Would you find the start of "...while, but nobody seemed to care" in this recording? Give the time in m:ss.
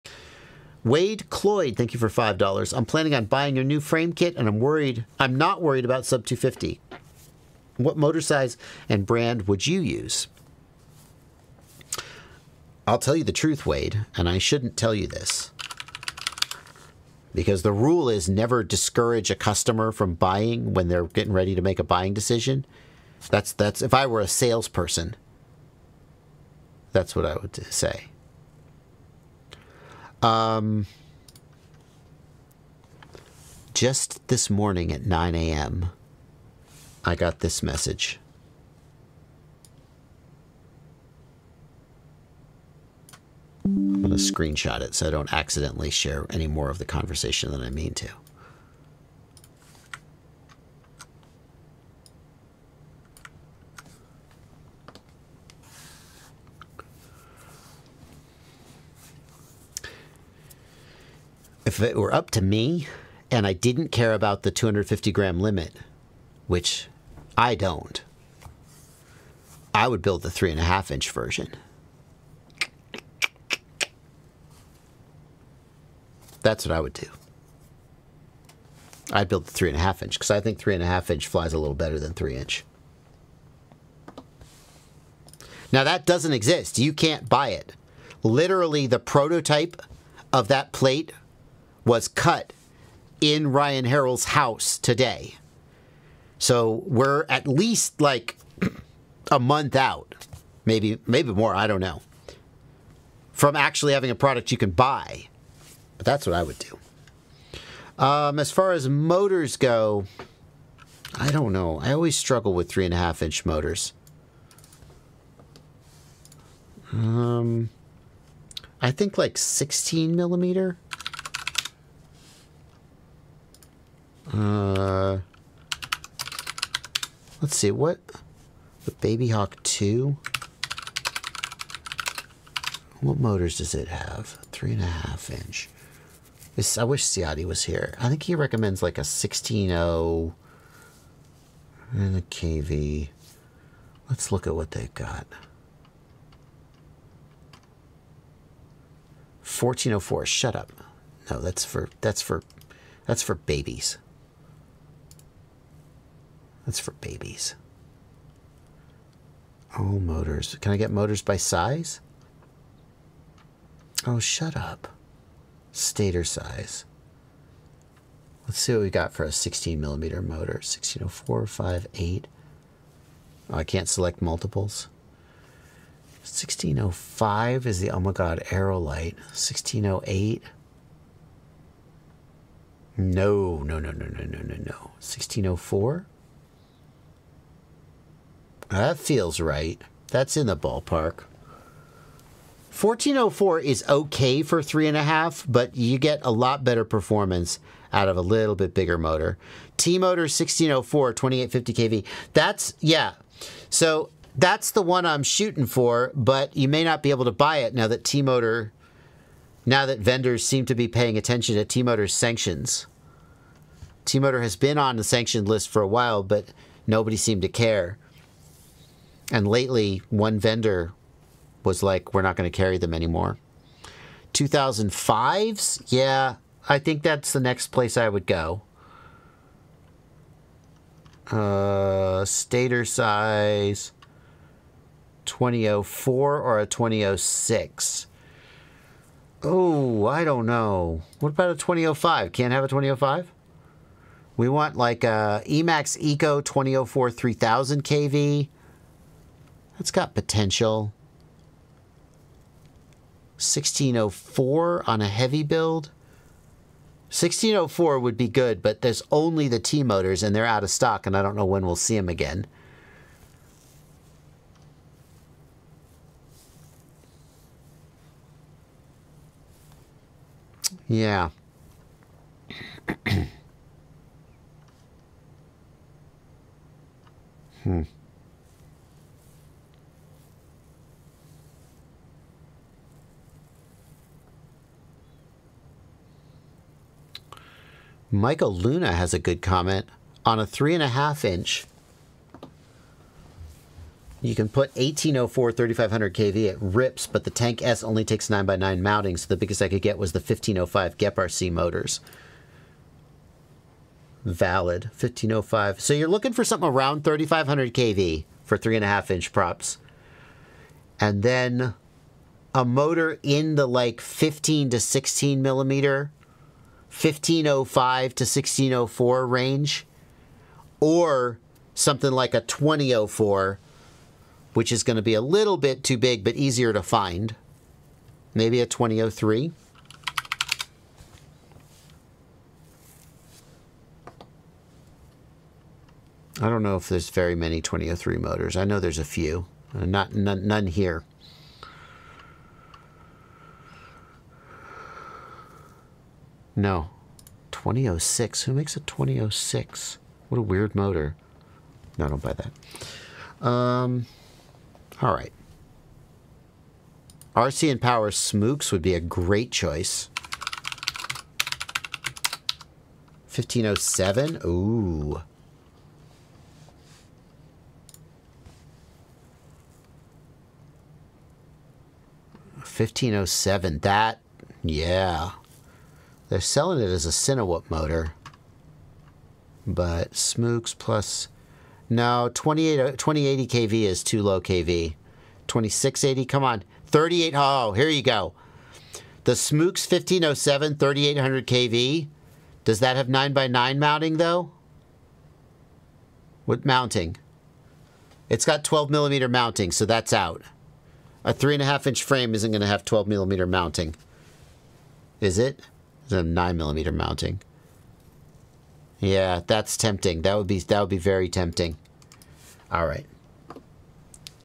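3:35.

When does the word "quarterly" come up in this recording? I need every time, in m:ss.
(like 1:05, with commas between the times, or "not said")
not said.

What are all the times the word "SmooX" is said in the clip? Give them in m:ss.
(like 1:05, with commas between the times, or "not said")
5:58, 6:20, 6:29.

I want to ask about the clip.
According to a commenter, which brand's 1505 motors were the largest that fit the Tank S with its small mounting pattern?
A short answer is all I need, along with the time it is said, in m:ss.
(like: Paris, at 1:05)
GEPRC, at 5:00.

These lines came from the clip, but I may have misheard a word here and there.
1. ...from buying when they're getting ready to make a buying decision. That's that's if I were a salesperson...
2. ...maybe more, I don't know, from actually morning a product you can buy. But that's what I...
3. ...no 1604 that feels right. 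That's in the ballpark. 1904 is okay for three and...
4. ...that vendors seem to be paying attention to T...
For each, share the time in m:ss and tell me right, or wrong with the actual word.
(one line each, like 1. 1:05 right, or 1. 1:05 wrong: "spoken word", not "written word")
1. 0:19 right
2. 1:41 wrong: "having", not "morning"
3. 3:04 wrong: "1404", not "1904"
4. 3:29 right.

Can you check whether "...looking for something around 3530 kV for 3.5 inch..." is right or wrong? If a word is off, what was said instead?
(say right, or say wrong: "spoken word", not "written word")
wrong: "3500", not "3530".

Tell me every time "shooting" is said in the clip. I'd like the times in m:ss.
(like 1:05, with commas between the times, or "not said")
3:25.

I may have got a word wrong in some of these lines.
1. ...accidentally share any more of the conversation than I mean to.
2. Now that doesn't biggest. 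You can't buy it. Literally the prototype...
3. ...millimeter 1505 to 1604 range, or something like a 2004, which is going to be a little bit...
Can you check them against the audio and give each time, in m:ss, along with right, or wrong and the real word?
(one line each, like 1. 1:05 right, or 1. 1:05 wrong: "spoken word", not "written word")
1. 0:45 right
2. 1:25 wrong: "exist", not "biggest"
3. 5:15 right.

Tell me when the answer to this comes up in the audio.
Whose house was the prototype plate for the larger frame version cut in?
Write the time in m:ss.
1:33.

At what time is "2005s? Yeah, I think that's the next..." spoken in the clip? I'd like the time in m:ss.
3:44.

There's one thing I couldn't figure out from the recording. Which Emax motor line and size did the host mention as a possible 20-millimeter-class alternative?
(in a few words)
Emax Eco 2004.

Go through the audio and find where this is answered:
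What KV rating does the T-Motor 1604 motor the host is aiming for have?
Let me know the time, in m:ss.
3:21.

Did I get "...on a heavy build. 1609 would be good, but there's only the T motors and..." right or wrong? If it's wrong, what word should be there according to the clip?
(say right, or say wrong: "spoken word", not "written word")
wrong: "1604", not "1609".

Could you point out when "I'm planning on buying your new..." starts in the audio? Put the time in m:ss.
0:02.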